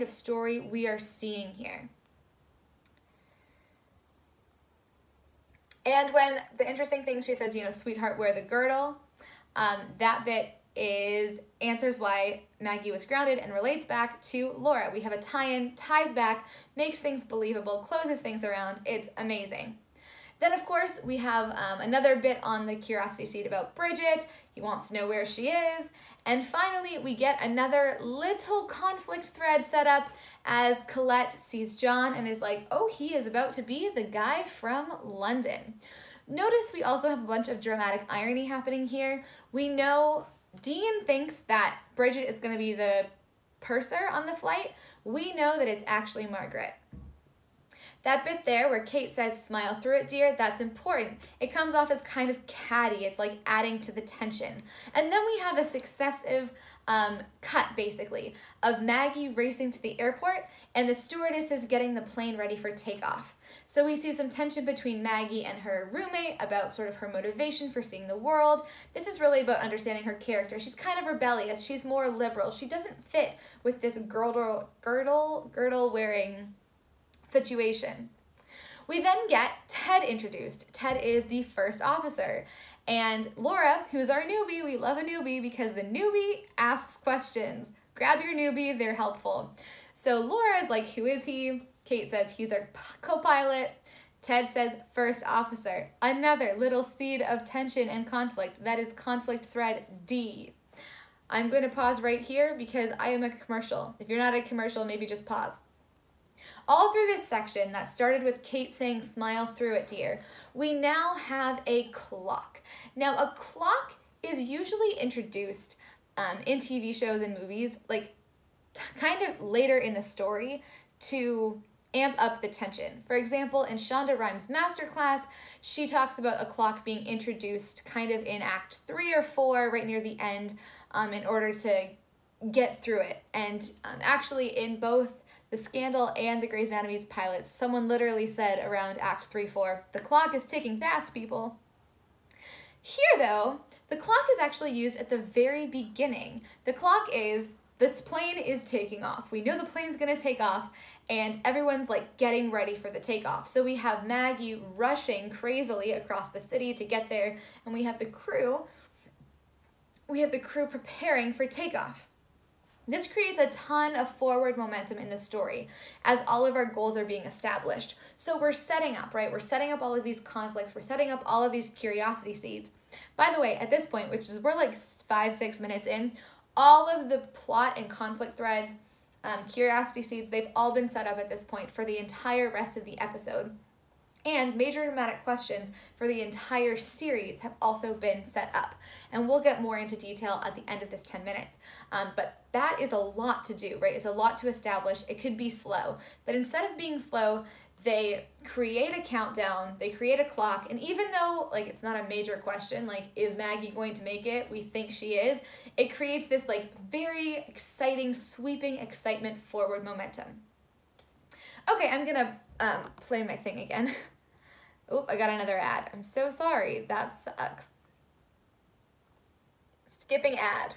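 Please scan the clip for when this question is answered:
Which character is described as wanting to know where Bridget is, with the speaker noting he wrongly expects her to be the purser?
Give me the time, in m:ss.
0:40.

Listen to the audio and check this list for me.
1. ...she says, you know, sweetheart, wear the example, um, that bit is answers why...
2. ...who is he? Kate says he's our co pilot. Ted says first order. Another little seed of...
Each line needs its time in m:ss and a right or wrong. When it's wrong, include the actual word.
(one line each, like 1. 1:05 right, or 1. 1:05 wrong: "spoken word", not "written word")
1. 0:07 wrong: "girdle", not "example"
2. 1:30 wrong: "officer", not "order".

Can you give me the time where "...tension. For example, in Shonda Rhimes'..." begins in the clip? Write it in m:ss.
2:02.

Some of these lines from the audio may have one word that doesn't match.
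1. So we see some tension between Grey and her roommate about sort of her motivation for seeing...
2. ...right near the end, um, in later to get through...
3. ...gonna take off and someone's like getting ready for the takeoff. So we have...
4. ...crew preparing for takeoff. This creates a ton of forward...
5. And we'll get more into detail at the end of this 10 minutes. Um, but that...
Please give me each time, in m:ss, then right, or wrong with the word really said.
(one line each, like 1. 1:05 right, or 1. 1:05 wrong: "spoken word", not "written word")
1. 1:03 wrong: "Maggie", not "Grey"
2. 2:09 wrong: "order", not "later"
3. 2:29 wrong: "everyone", not "someone"
4. 2:40 right
5. 3:09 right.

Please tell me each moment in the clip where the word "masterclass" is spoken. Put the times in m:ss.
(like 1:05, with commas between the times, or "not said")
2:04.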